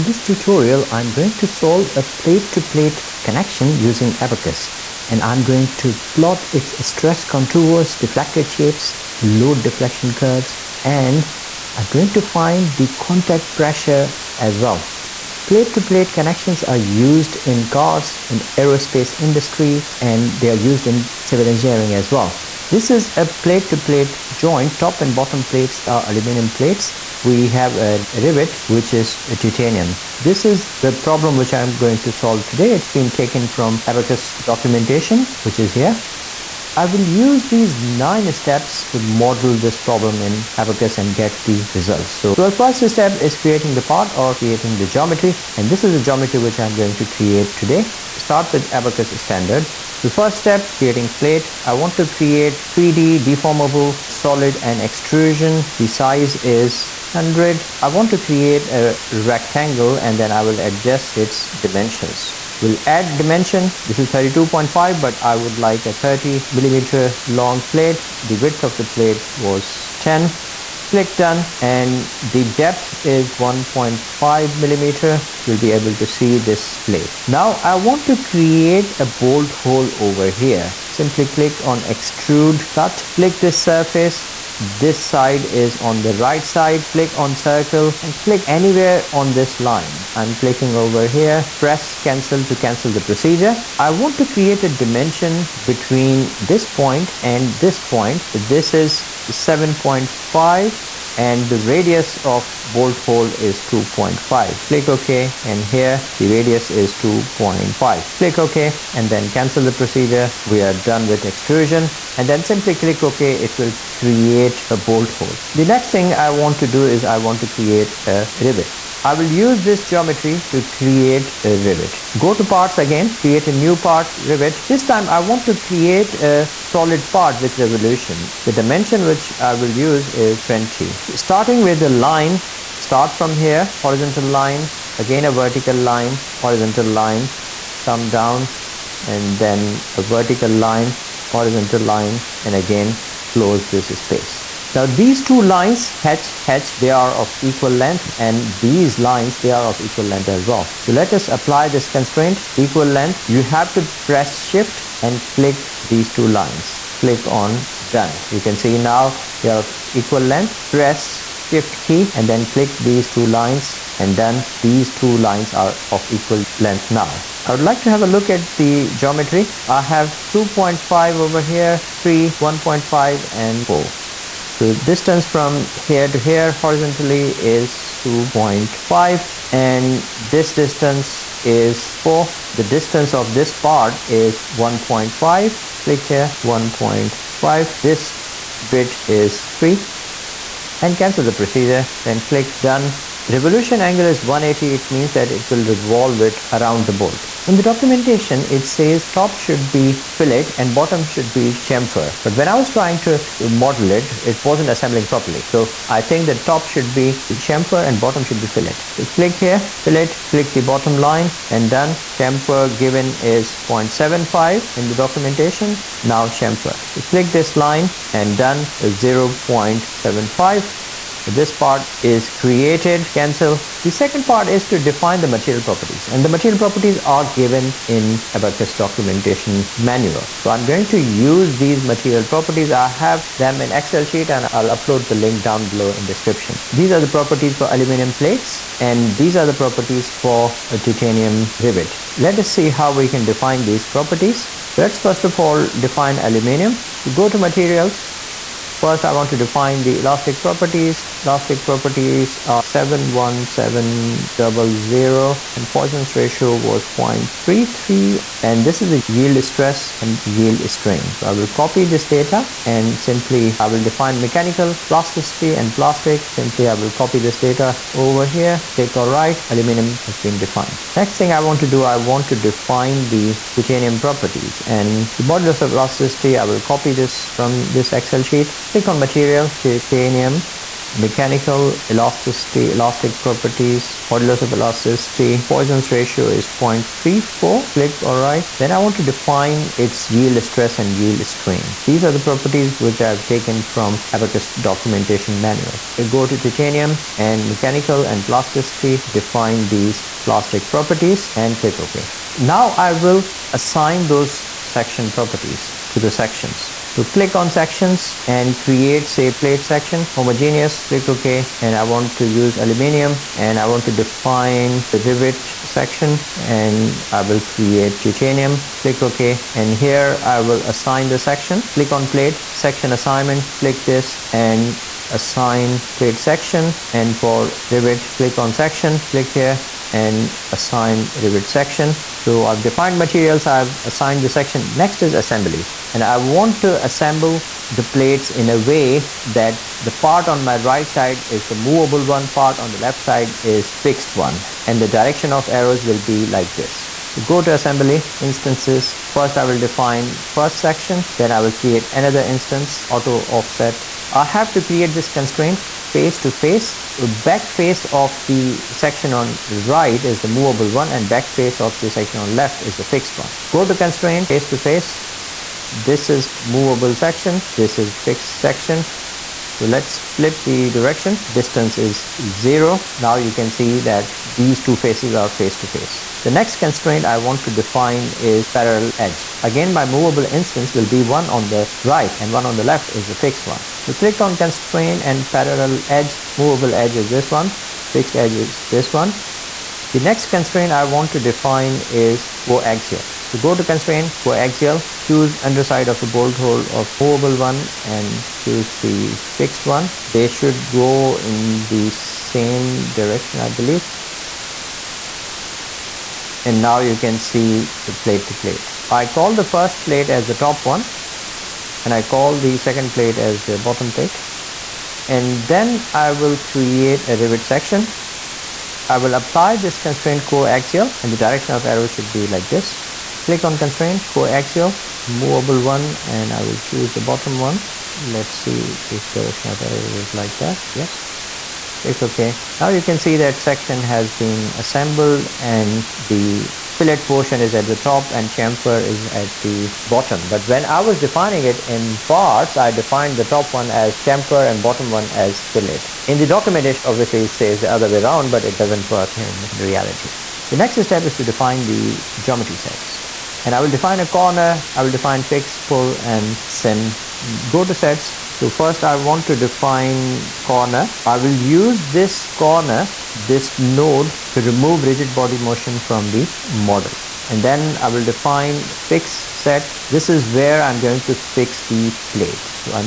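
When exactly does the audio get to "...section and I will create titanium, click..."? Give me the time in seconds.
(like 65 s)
315 s.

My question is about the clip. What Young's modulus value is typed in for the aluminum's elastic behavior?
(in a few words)
71700.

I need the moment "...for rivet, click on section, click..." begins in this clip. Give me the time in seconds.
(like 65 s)
327 s.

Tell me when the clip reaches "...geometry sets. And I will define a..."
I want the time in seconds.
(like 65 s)
452 s.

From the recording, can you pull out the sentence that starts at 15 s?
Plate-to-plate -plate connections are used in cars, in aerospace industry, and they are used in civil engineering as well.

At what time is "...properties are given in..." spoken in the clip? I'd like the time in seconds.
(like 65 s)
226 s.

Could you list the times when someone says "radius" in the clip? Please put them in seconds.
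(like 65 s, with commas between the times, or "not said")
101 s, 106 s.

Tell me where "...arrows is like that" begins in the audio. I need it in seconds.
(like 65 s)
429 s.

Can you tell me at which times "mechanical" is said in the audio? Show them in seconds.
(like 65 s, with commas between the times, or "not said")
264 s, 280 s, 297 s.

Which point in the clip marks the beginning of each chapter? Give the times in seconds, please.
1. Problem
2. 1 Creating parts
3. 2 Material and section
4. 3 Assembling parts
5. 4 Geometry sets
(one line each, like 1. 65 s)
1. 22 s
2. 42 s
3. 223 s
4. 333 s
5. 450 s.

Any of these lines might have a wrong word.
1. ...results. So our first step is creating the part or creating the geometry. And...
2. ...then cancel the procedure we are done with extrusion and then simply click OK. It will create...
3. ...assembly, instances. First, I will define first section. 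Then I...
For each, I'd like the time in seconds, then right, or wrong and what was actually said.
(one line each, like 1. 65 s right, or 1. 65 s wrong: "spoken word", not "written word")
1. 41 s right
2. 109 s right
3. 347 s right.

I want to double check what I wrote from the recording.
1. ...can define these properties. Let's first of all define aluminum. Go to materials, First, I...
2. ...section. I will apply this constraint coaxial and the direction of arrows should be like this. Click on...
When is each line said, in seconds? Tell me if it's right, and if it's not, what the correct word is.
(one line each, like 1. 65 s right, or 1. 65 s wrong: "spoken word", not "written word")
1. 243 s right
2. 417 s right.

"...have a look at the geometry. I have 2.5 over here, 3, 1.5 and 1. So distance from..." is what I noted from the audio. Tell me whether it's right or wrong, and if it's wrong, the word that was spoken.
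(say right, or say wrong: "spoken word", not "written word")
wrong: "4", not "1".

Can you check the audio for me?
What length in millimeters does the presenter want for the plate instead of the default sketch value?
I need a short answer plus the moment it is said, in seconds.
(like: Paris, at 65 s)
30, at 65 s.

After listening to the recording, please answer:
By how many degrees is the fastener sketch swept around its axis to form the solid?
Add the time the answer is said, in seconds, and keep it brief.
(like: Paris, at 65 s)
180, at 194 s.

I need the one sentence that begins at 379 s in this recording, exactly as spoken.
Again, my movable instance will be one on the right and one on the left is the fixed one.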